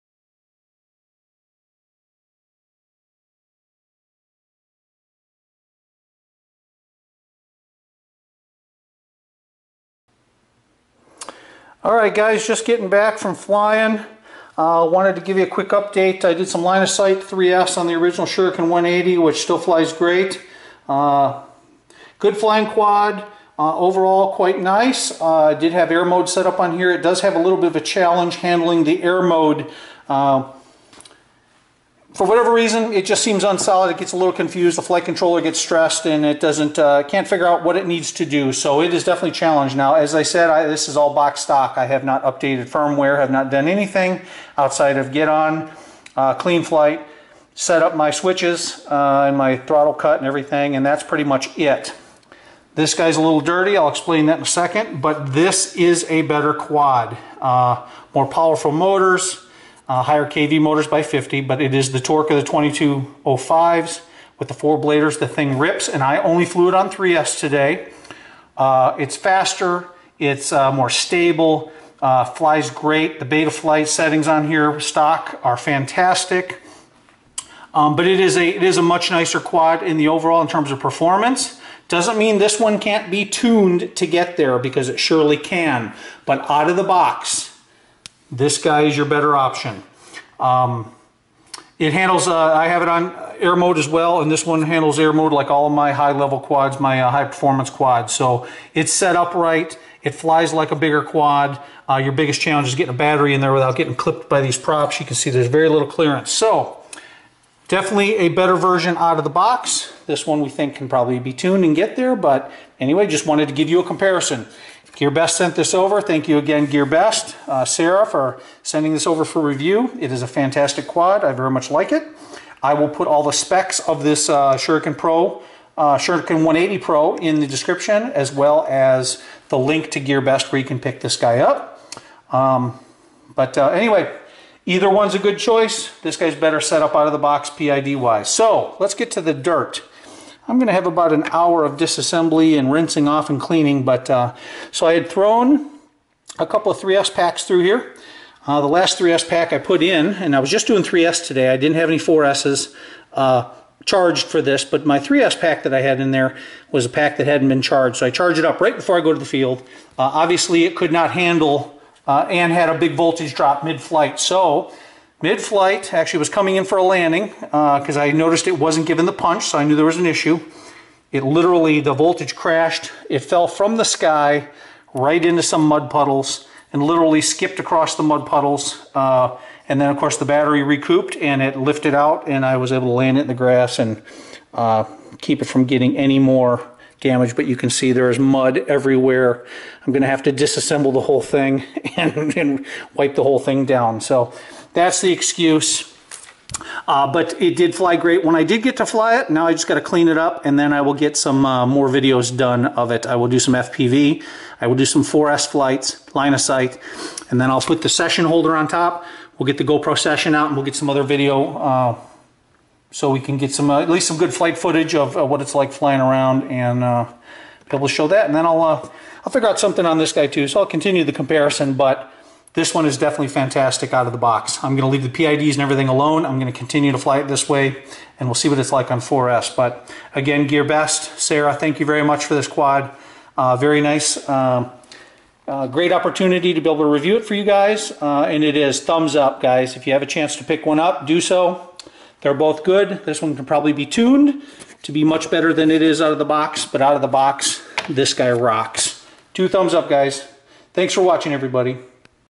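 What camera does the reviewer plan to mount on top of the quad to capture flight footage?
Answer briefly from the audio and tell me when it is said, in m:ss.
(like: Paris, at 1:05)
GoPro Session, at 3:29.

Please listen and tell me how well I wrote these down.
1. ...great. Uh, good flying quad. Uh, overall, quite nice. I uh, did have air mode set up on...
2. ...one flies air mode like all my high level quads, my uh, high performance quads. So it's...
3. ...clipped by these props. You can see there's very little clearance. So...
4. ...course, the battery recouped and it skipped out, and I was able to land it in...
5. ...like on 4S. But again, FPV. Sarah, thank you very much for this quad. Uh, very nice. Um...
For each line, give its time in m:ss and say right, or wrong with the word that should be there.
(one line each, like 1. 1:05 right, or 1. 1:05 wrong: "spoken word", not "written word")
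1. 0:19 right
2. 1:34 wrong: "handles", not "flies"
3. 1:43 right
4. 2:59 wrong: "lifted", not "skipped"
5. 3:48 wrong: "GearBest", not "FPV".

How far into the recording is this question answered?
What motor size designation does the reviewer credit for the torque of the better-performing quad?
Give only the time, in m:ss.
1:02.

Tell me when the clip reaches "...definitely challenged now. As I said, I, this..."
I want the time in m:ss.
0:39.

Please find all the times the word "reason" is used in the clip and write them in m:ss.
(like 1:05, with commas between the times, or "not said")
0:32.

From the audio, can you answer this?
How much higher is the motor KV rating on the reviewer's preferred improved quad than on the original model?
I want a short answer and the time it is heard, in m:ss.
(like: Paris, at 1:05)
50, at 1:01.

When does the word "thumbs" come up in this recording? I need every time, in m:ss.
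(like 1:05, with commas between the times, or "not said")
3:58, 4:09.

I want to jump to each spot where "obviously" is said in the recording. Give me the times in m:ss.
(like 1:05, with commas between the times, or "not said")
2:40.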